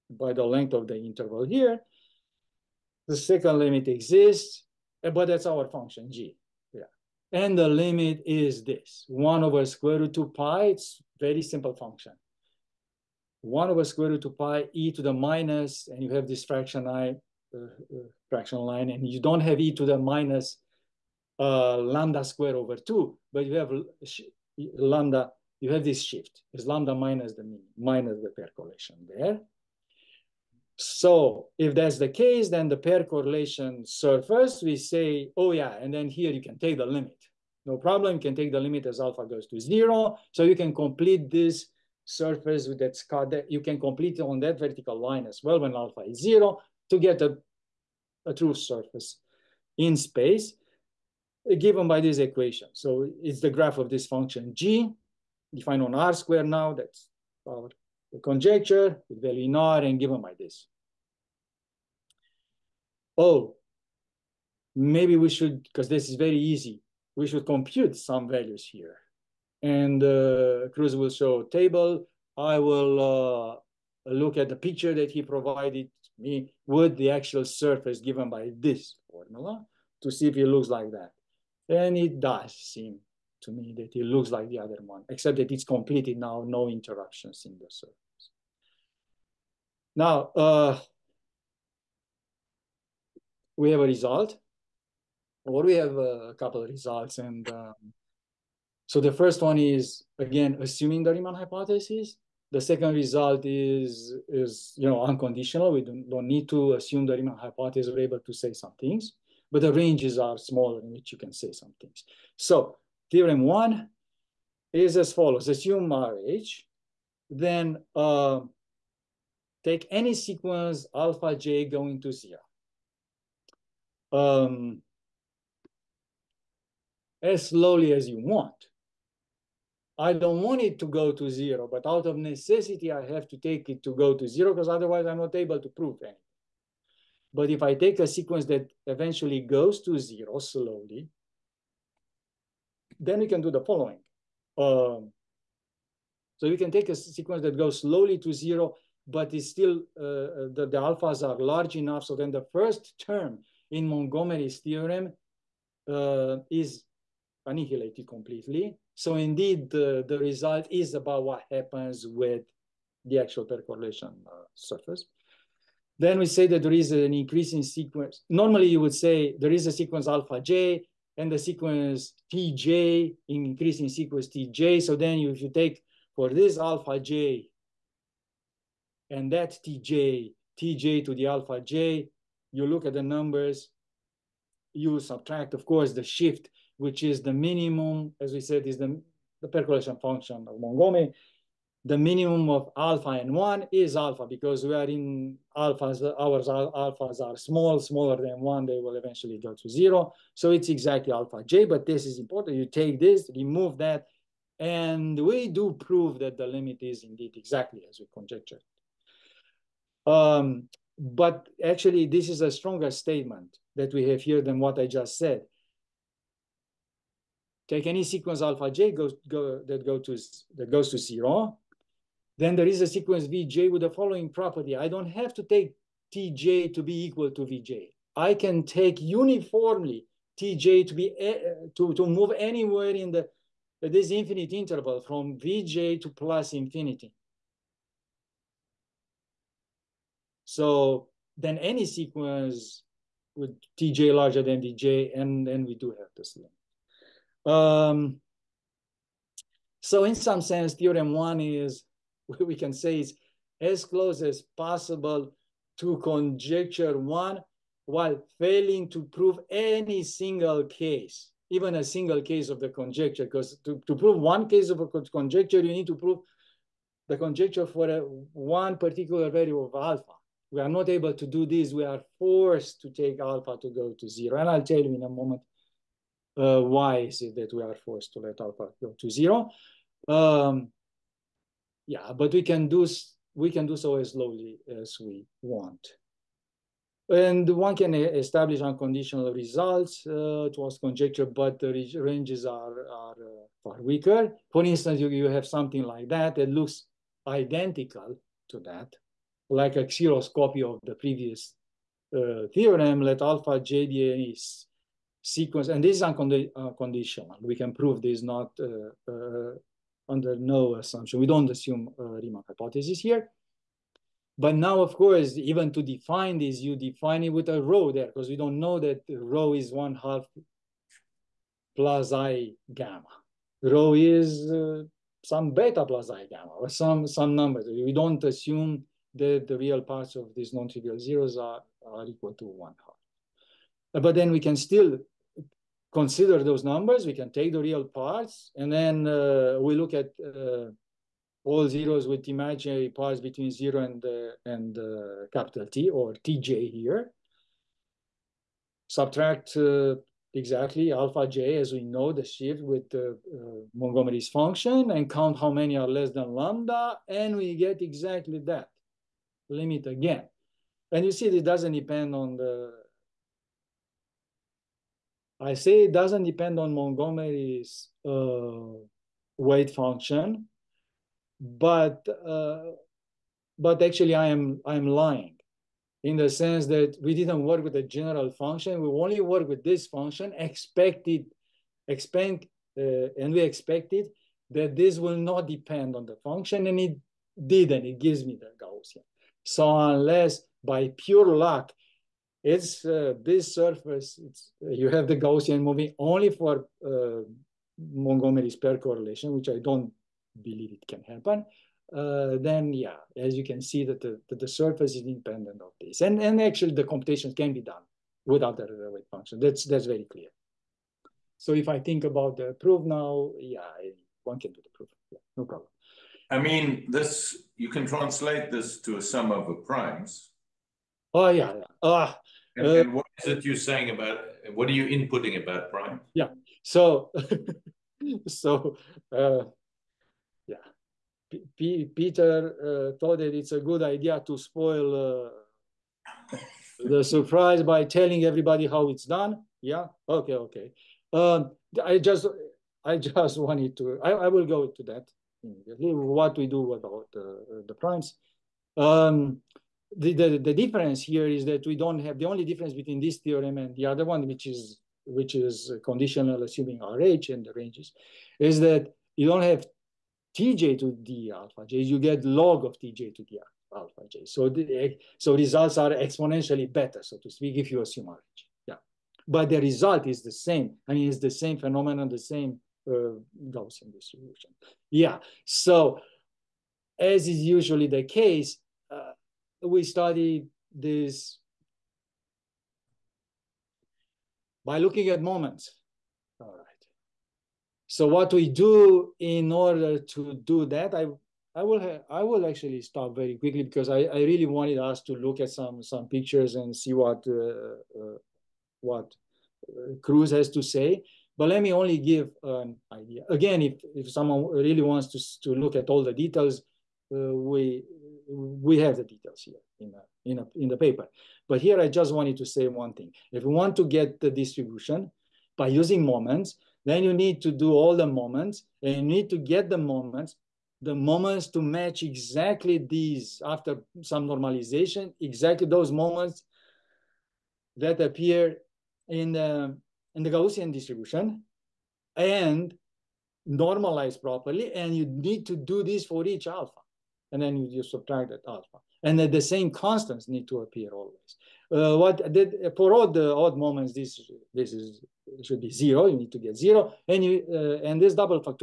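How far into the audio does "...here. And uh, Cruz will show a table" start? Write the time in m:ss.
1:08.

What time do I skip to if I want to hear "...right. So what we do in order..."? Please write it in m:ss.
8:06.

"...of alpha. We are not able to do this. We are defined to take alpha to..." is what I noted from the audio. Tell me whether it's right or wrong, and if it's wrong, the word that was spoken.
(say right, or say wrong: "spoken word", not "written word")
wrong: "forced", not "defined".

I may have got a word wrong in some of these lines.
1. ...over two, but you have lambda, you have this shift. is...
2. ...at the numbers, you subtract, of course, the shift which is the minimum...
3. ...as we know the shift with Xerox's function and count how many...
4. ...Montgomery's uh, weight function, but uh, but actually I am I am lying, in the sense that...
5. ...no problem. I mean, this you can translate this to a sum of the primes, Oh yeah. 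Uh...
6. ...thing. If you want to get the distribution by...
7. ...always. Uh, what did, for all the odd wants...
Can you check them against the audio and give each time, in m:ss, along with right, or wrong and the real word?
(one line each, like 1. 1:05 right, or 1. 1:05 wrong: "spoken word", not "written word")
1. 0:22 right
2. 3:02 right
3. 5:51 wrong: "Montgomery", not "Xerox"
4. 6:06 right
5. 6:55 right
6. 8:32 right
7. 9:00 wrong: "moments", not "wants".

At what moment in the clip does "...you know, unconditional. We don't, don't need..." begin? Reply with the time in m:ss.
1:44.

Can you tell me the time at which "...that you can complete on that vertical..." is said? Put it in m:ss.
0:43.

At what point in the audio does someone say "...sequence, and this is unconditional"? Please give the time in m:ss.
5:05.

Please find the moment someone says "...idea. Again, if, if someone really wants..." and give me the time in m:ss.
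8:22.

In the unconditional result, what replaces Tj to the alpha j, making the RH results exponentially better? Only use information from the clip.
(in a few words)
log of Tj.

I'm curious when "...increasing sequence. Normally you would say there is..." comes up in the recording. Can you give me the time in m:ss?
2:47.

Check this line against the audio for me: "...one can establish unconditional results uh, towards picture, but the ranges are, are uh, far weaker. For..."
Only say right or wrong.
wrong.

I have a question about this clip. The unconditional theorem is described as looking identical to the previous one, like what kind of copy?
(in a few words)
Xerox copy.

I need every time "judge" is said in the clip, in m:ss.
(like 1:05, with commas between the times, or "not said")
not said.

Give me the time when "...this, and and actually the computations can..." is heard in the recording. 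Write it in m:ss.
6:45.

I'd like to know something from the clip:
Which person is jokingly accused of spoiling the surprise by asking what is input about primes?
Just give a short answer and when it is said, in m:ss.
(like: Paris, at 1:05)
Peter, at 7:11.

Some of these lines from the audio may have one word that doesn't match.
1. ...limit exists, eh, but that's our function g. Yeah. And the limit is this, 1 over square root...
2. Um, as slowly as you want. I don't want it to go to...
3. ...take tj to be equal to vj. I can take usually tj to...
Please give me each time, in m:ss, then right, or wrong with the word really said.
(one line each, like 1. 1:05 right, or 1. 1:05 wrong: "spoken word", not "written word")
1. 0:03 right
2. 2:04 right
3. 3:45 wrong: "uniformly", not "usually".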